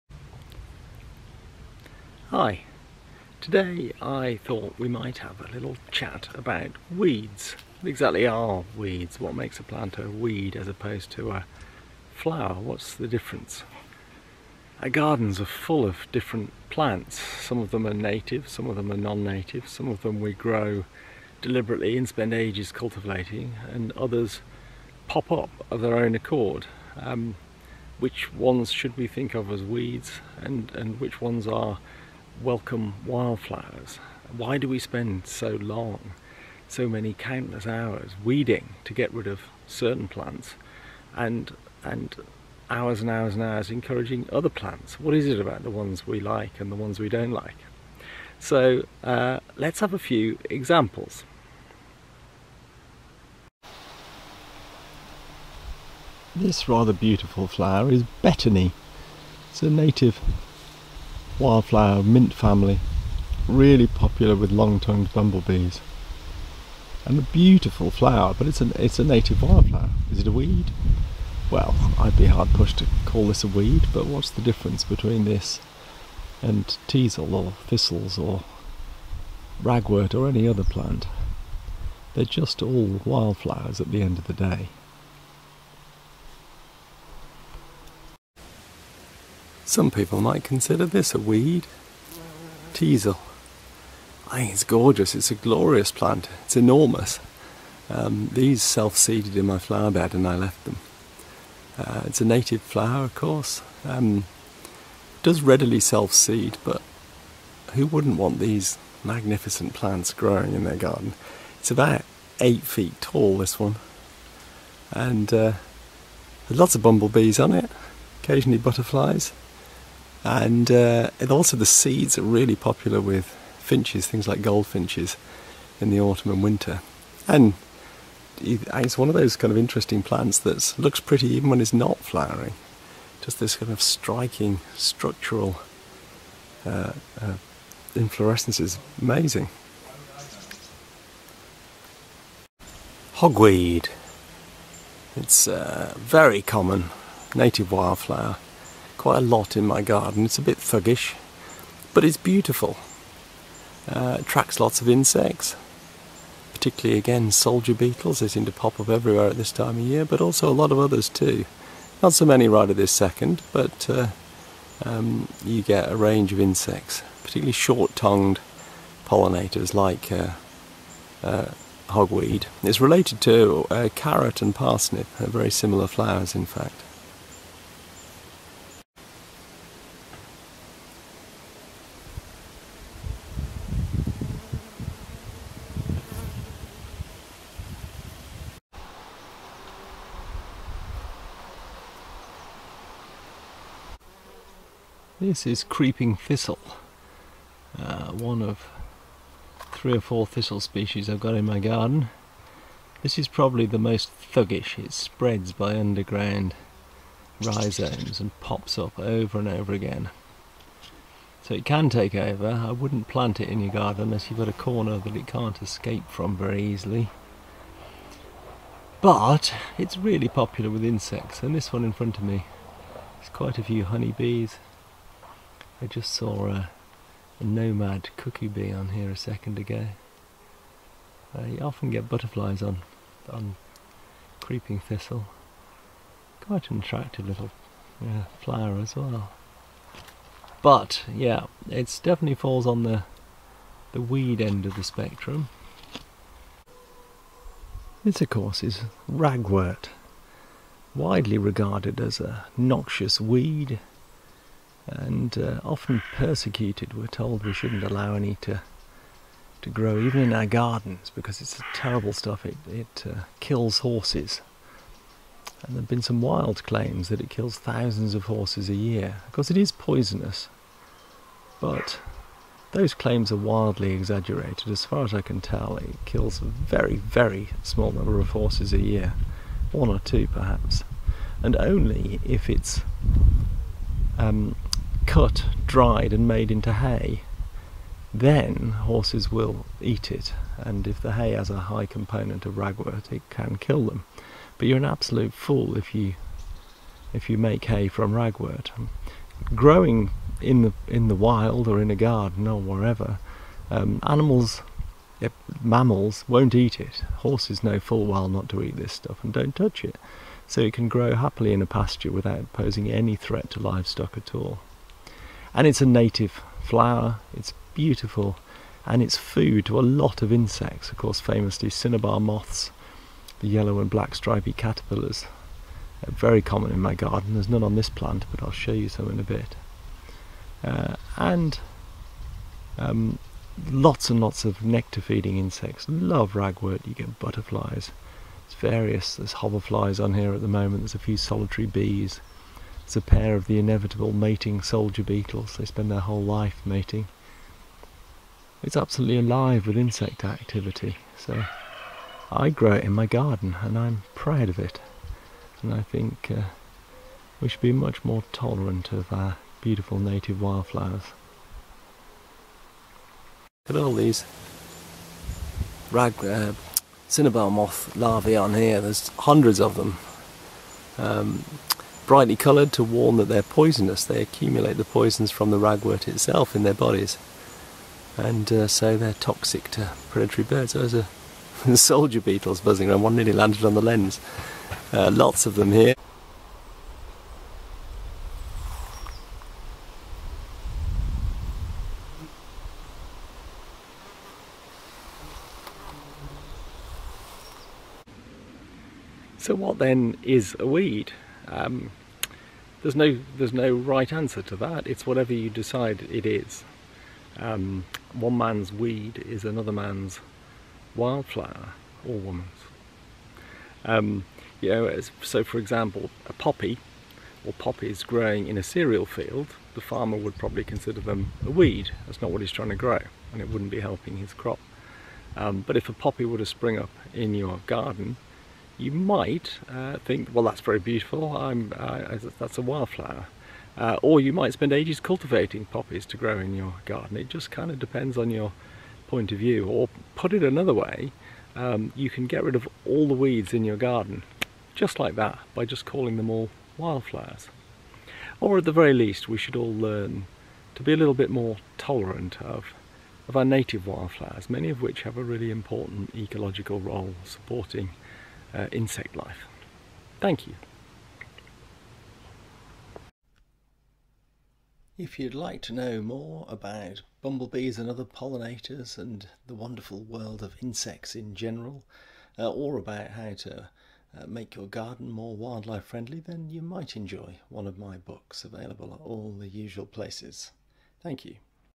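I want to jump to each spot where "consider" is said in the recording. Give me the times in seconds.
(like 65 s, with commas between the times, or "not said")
90 s, 420 s.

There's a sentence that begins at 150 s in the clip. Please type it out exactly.
It's a bit thuggish, but it's beautiful.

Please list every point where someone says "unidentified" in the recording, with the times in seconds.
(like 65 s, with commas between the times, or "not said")
not said.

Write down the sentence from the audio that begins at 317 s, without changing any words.
It's beautiful and it's food to a lot of insects, of course, famously cinnabar moths, the yellow and black stripy caterpillars.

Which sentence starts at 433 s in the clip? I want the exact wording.
Uh, or you might spend ages cultivating poppies to grow in your garden.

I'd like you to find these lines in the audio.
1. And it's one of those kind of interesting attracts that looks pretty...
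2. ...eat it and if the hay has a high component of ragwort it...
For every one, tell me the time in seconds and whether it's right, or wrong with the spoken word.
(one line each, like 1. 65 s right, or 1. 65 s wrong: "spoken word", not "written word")
1. 127 s wrong: "plants", not "attracts"
2. 289 s right.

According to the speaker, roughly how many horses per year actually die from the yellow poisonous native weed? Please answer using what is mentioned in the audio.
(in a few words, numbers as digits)
1 or 2.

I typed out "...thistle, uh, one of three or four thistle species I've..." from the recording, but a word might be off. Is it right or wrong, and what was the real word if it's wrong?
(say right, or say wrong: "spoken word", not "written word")
right.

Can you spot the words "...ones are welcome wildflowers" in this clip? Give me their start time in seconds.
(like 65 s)
31 s.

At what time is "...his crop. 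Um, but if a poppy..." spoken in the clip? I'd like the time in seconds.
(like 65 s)
424 s.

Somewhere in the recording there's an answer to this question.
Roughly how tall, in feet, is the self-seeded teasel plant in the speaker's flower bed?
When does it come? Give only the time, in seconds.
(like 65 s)
112 s.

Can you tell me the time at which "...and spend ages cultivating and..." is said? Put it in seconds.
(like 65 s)
21 s.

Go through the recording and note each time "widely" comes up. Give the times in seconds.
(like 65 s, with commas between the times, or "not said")
250 s.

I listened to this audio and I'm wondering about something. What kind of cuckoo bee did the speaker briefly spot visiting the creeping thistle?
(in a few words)
nomad cuckoo bee.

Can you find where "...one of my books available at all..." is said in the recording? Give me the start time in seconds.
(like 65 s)
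477 s.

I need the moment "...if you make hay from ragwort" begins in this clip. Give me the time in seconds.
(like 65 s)
297 s.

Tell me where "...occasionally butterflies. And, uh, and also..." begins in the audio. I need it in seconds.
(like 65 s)
118 s.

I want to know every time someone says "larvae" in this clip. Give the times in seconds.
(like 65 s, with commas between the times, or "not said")
367 s.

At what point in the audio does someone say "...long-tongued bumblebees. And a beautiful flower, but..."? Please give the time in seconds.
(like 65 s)
64 s.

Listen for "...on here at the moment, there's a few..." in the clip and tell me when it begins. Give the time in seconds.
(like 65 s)
340 s.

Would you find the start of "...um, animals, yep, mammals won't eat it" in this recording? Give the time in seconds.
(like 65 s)
303 s.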